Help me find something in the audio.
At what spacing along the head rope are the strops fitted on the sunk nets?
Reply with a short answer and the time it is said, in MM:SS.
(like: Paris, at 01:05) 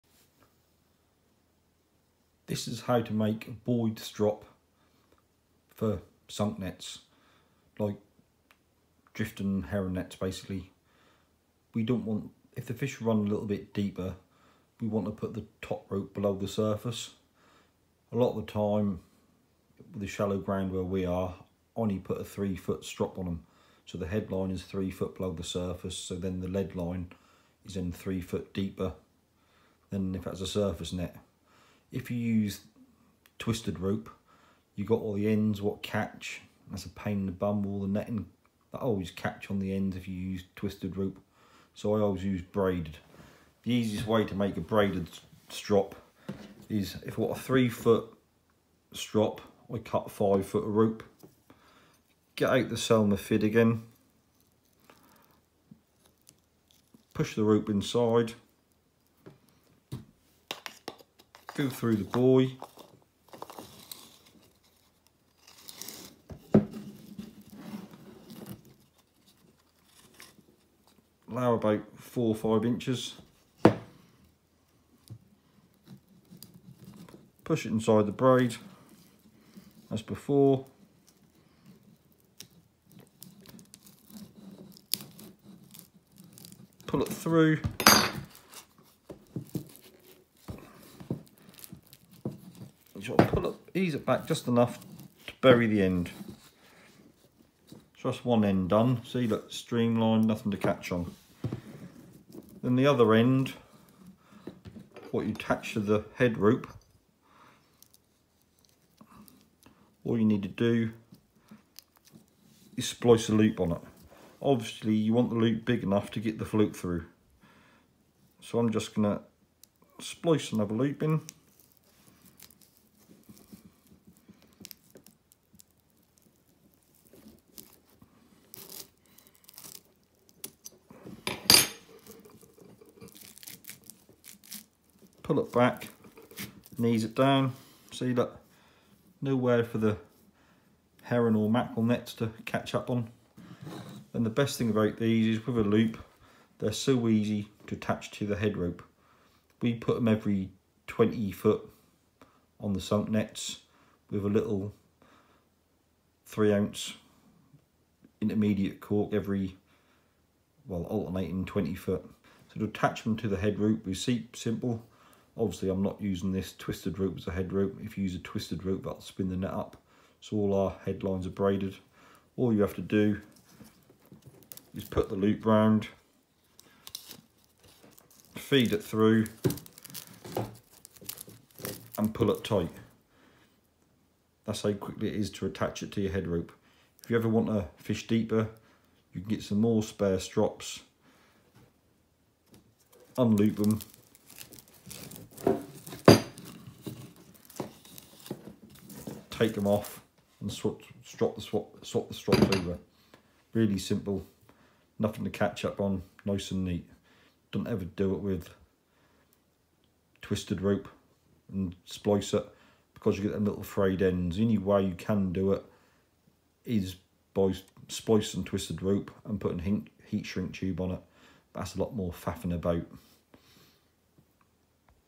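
20 feet, at 02:30.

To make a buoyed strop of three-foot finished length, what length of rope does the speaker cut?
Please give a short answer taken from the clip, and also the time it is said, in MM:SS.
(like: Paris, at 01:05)
5 feet, at 00:50.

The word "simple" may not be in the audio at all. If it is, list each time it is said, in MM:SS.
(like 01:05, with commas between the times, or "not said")
02:44, 03:23.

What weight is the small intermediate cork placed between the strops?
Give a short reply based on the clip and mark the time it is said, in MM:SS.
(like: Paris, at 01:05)
3 ounces, at 02:36.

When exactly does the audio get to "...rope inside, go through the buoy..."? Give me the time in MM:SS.
00:57.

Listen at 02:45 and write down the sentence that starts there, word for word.
Obviously, I'm not using this twisted rope as a head rope.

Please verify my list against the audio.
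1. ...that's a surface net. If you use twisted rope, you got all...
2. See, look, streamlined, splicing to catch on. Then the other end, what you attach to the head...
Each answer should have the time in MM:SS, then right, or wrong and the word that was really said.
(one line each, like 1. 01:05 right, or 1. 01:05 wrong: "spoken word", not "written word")
1. 00:30 right
2. 01:39 wrong: "nothing", not "splicing".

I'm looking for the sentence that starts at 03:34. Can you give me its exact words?
The only way you can do it is by splicing twisted rope and putting heat shrink tube on it.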